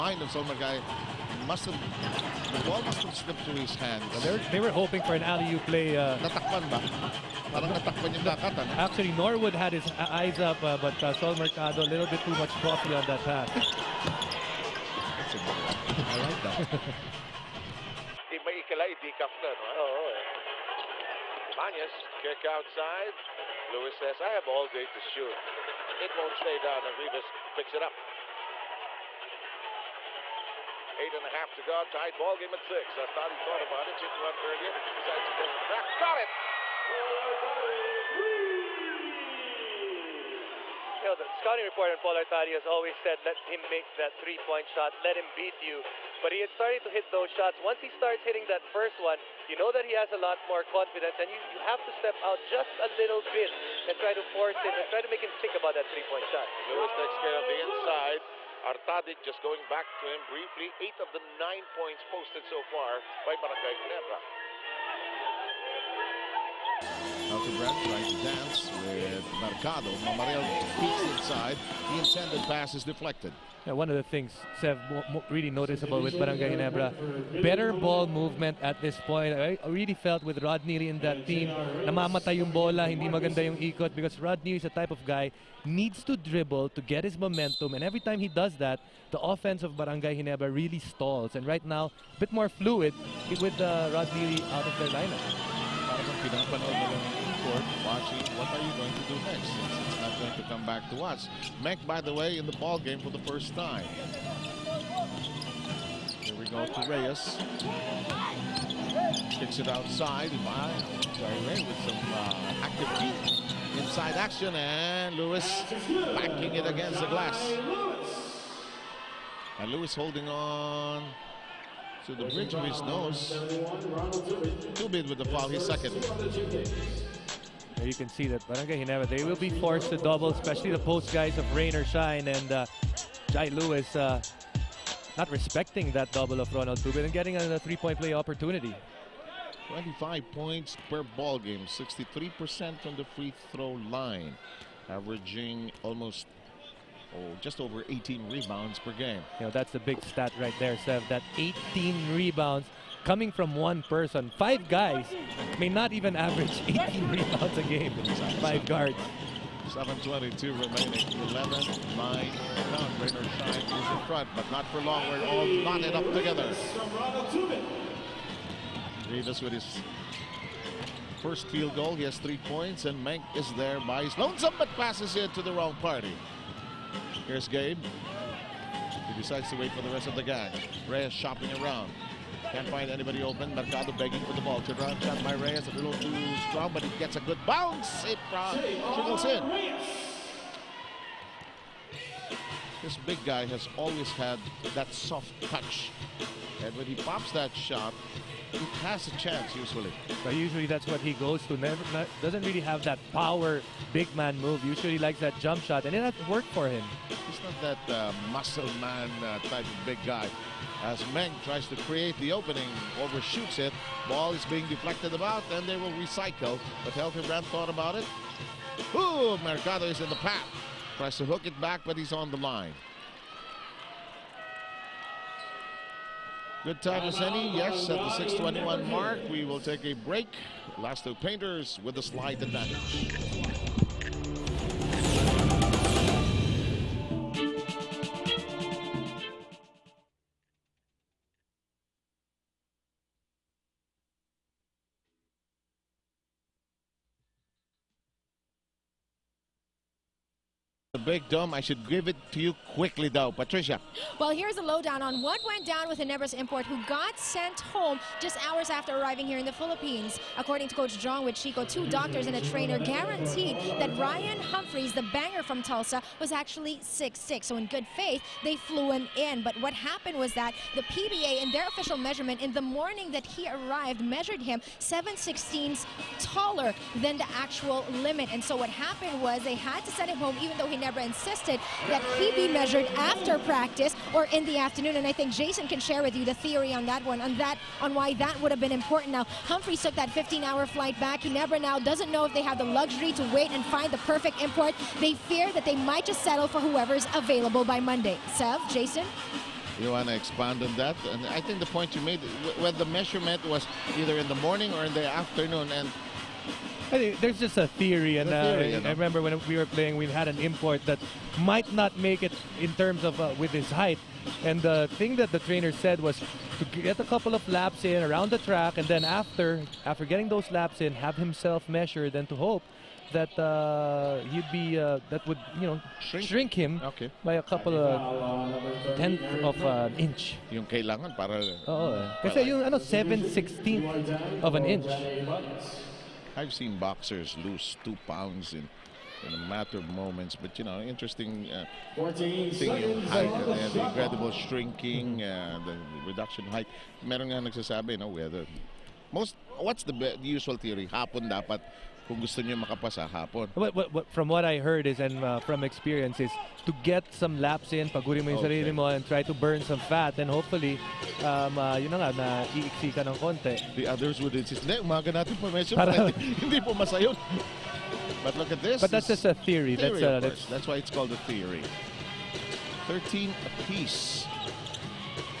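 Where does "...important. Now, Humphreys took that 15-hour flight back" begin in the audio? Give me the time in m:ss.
4:48.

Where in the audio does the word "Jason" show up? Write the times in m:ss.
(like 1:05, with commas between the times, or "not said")
4:45, 4:58.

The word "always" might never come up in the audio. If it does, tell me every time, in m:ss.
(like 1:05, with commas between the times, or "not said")
0:42, 3:13.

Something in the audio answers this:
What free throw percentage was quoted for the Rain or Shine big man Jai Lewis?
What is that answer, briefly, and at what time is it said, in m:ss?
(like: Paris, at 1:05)
63%, at 2:21.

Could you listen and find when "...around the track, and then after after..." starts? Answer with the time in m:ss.
5:18.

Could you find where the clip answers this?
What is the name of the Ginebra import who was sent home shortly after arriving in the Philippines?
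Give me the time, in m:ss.
4:23.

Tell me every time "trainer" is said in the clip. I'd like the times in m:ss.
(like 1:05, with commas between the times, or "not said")
4:22, 5:15.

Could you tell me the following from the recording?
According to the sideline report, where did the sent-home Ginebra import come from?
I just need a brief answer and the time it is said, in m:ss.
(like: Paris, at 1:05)
Tulsa, at 4:25.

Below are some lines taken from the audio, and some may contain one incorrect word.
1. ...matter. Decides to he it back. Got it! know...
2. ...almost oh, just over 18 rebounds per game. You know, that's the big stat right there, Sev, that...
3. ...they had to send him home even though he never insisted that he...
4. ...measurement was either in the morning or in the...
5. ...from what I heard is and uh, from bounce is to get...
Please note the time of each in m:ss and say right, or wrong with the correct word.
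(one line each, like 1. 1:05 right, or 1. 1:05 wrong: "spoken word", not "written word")
1. 0:34 wrong: "earlier", not "matter"
2. 2:25 right
3. 4:39 right
4. 5:02 right
5. 5:54 wrong: "experience", not "bounce".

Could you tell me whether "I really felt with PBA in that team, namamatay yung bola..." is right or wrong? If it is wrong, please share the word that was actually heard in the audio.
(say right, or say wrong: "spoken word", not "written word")
wrong: "Rodney", not "PBA".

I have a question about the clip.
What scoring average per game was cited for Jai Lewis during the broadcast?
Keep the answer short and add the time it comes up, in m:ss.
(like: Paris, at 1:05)
25 points, at 2:19.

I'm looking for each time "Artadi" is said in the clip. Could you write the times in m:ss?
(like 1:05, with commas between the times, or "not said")
0:42, 0:58.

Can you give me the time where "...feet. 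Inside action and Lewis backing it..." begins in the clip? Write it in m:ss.
1:52.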